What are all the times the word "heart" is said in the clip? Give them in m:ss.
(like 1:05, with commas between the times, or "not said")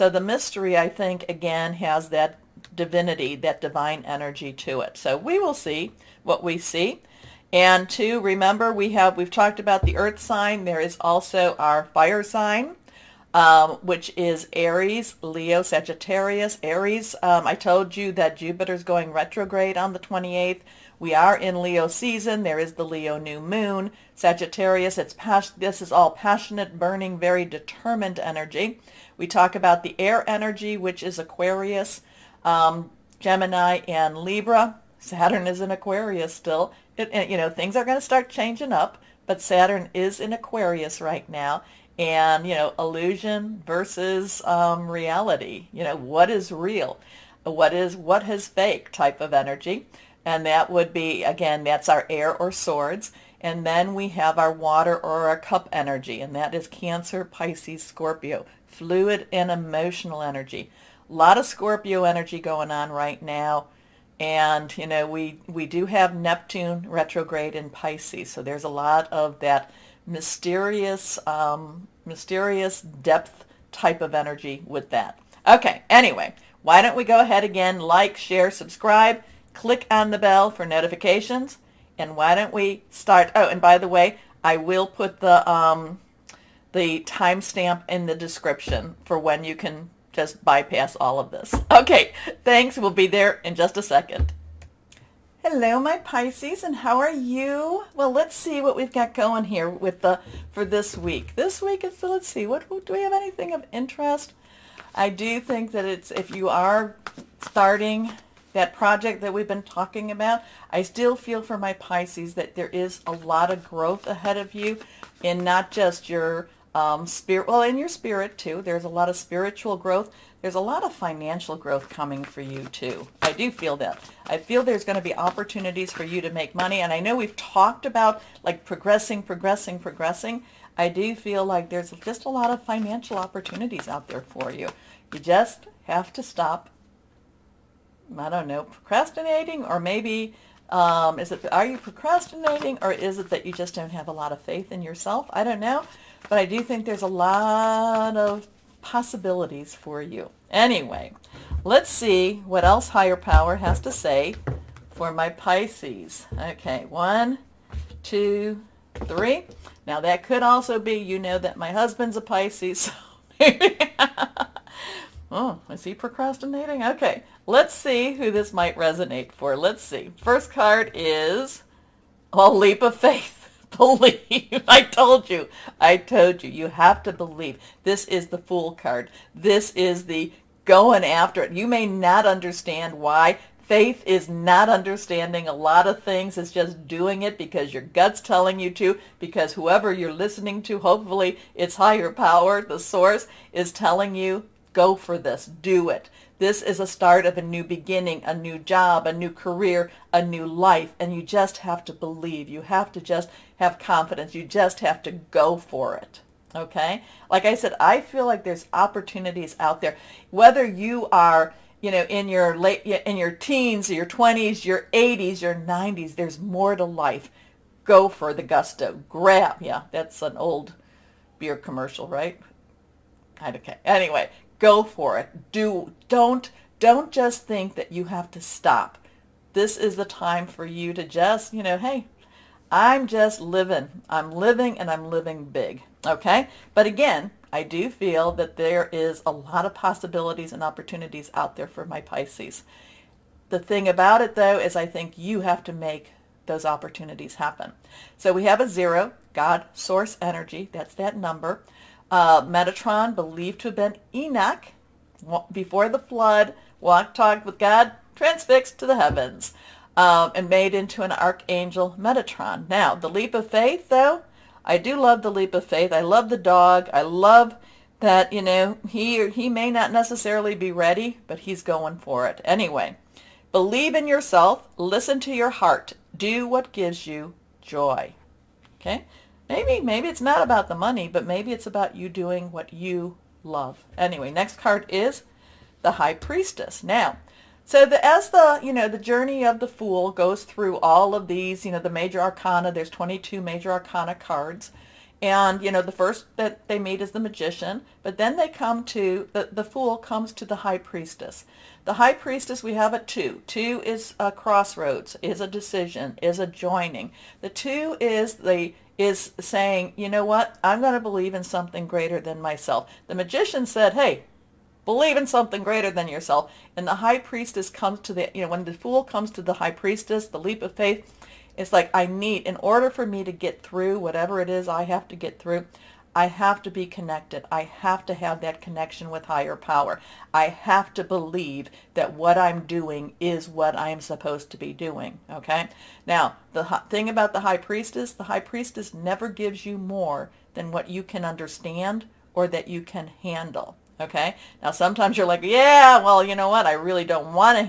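4:35.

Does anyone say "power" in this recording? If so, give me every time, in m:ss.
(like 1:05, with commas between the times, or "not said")
2:33, 3:12, 5:29.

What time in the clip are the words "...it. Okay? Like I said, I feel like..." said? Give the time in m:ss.
3:25.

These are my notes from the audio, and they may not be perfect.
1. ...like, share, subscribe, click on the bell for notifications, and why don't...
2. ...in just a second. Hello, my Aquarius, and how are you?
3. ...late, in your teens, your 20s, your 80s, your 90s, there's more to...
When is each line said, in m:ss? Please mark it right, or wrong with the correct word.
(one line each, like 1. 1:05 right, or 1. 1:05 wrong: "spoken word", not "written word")
1. 1:17 right
2. 1:33 wrong: "Pisces", not "Aquarius"
3. 3:32 right.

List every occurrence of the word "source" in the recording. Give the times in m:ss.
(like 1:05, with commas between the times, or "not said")
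3:12, 4:09.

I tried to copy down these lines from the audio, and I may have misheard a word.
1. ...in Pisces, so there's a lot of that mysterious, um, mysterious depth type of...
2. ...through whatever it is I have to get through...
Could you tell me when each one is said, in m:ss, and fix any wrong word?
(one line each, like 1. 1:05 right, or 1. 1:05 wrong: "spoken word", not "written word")
1. 1:07 right
2. 5:23 right.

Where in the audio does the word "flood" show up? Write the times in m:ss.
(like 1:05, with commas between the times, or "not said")
4:15.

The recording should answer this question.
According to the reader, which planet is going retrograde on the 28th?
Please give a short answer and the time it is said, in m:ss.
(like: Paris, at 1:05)
Jupiter, at 0:18.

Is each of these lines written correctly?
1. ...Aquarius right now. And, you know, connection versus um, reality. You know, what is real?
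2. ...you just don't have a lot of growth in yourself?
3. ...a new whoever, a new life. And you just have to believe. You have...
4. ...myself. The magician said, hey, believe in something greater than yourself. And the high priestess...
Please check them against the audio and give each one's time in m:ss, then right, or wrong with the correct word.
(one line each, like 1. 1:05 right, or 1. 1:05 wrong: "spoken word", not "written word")
1. 0:40 wrong: "illusion", not "connection"
2. 2:23 wrong: "faith", not "growth"
3. 3:19 wrong: "career", not "whoever"
4. 5:12 right.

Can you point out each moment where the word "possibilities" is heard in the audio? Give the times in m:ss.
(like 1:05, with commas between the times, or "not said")
2:28, 3:59.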